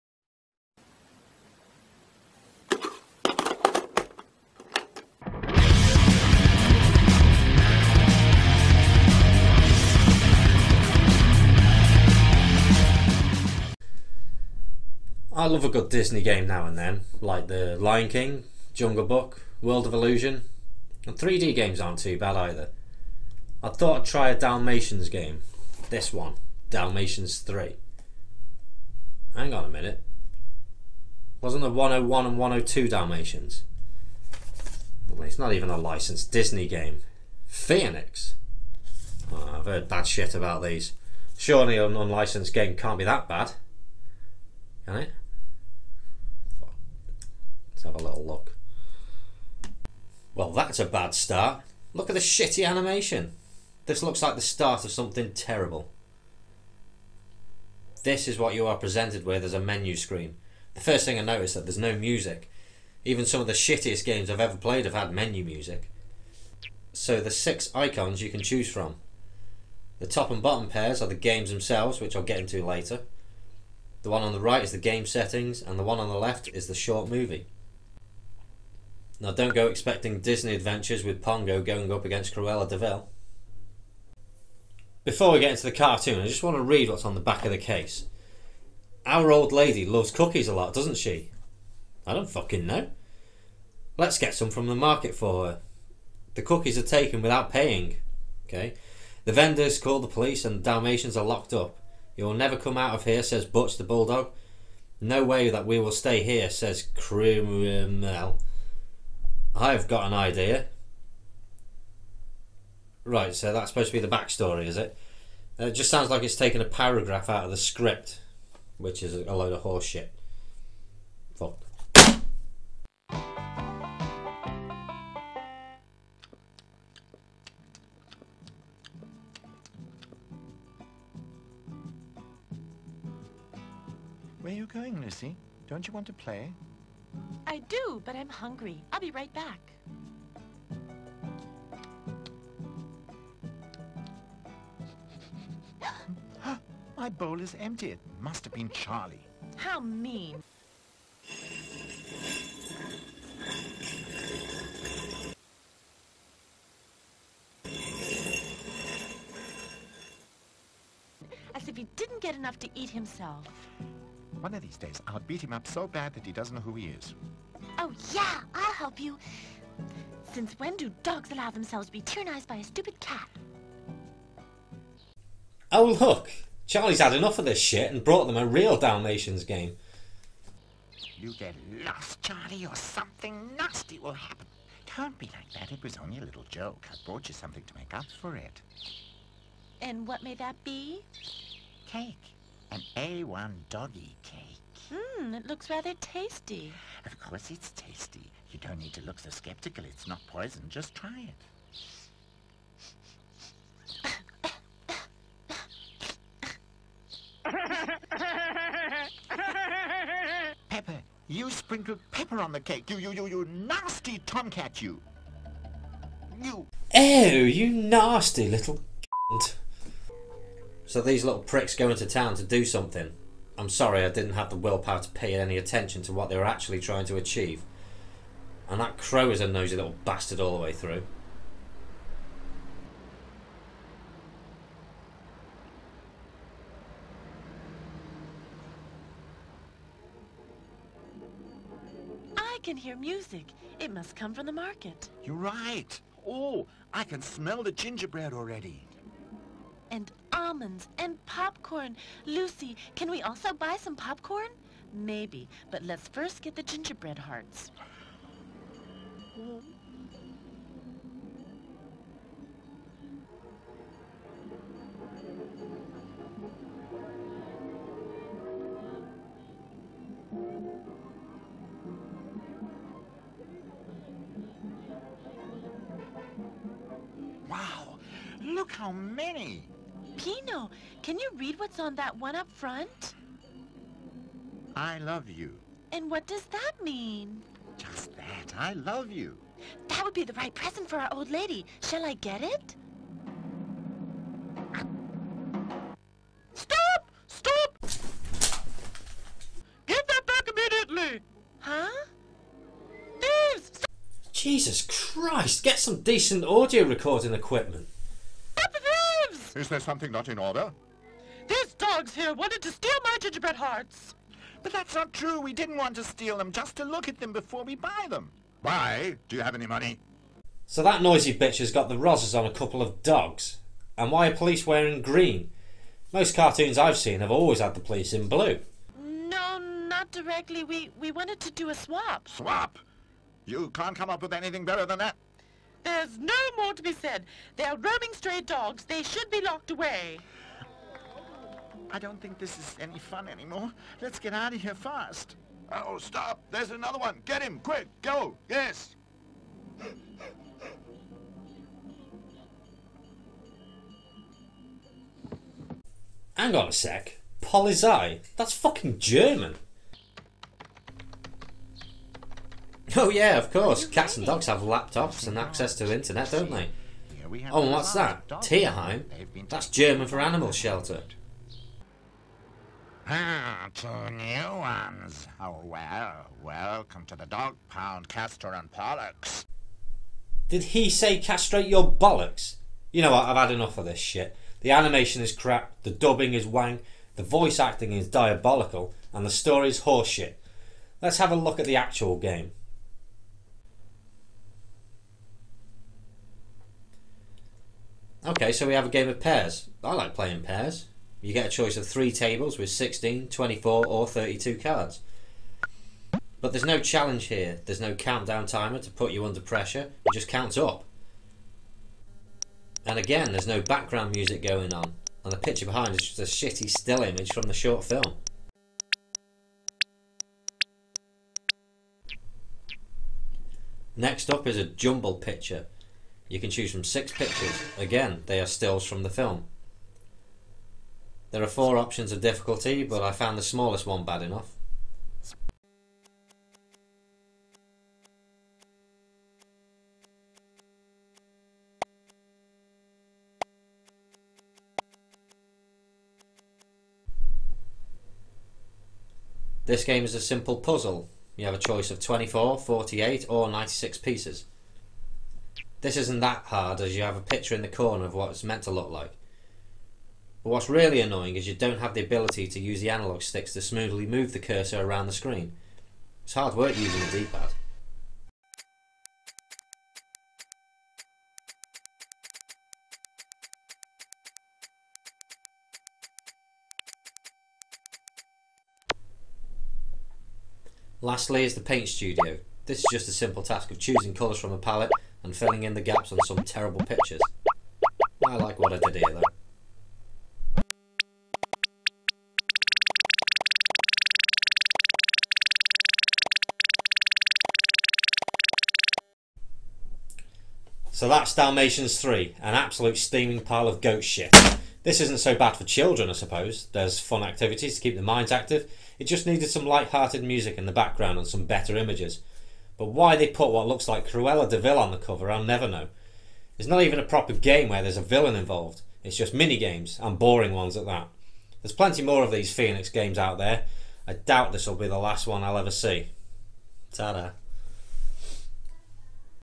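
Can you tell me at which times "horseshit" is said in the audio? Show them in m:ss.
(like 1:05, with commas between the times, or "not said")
1:59, 6:29.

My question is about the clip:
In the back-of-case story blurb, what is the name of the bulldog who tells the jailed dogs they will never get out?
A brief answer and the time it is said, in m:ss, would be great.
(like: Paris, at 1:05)
Butch, at 1:43.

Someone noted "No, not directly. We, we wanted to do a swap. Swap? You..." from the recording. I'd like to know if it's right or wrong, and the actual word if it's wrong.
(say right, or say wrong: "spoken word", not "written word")
right.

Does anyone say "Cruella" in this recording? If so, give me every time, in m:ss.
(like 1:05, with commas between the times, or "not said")
1:22, 8:34.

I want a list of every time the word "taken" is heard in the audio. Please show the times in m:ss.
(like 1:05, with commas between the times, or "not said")
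1:36, 1:56.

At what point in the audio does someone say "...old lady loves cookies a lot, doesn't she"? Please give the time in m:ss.
1:29.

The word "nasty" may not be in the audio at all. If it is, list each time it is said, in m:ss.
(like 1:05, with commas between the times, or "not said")
3:03, 3:33, 3:37.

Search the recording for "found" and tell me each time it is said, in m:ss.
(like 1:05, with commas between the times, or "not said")
7:13.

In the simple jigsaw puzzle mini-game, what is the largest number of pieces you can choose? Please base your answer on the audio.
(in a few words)
96.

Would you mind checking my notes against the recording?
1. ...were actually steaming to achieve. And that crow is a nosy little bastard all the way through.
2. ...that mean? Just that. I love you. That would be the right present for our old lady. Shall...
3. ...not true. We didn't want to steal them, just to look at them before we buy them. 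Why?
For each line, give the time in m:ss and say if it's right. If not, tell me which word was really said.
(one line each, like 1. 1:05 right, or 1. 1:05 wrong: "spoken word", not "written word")
1. 3:46 wrong: "trying", not "steaming"
2. 4:46 right
3. 5:14 right.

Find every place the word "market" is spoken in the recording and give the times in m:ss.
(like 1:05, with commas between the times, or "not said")
1:34, 4:04.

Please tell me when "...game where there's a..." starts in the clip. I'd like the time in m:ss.
8:37.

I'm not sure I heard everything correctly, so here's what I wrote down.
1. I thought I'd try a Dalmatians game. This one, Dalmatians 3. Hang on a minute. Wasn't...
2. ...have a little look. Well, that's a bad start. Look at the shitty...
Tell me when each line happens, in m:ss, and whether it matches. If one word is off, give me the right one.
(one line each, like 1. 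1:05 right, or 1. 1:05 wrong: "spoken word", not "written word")
1. 0:23 right
2. 0:47 right.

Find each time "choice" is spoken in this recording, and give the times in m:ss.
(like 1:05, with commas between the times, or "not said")
6:41, 7:31.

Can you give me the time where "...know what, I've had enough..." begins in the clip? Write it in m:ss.
6:23.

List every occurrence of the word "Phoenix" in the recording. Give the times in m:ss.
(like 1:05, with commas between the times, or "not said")
0:37, 8:42.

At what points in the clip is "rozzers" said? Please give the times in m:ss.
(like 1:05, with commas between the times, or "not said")
5:21.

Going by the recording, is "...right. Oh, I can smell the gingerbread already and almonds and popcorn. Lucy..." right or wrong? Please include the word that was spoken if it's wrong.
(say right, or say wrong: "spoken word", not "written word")
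right.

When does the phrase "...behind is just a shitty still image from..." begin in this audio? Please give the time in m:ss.
6:55.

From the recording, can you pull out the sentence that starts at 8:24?
This isn't so bad for children, I suppose.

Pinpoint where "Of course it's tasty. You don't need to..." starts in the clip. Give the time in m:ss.
3:17.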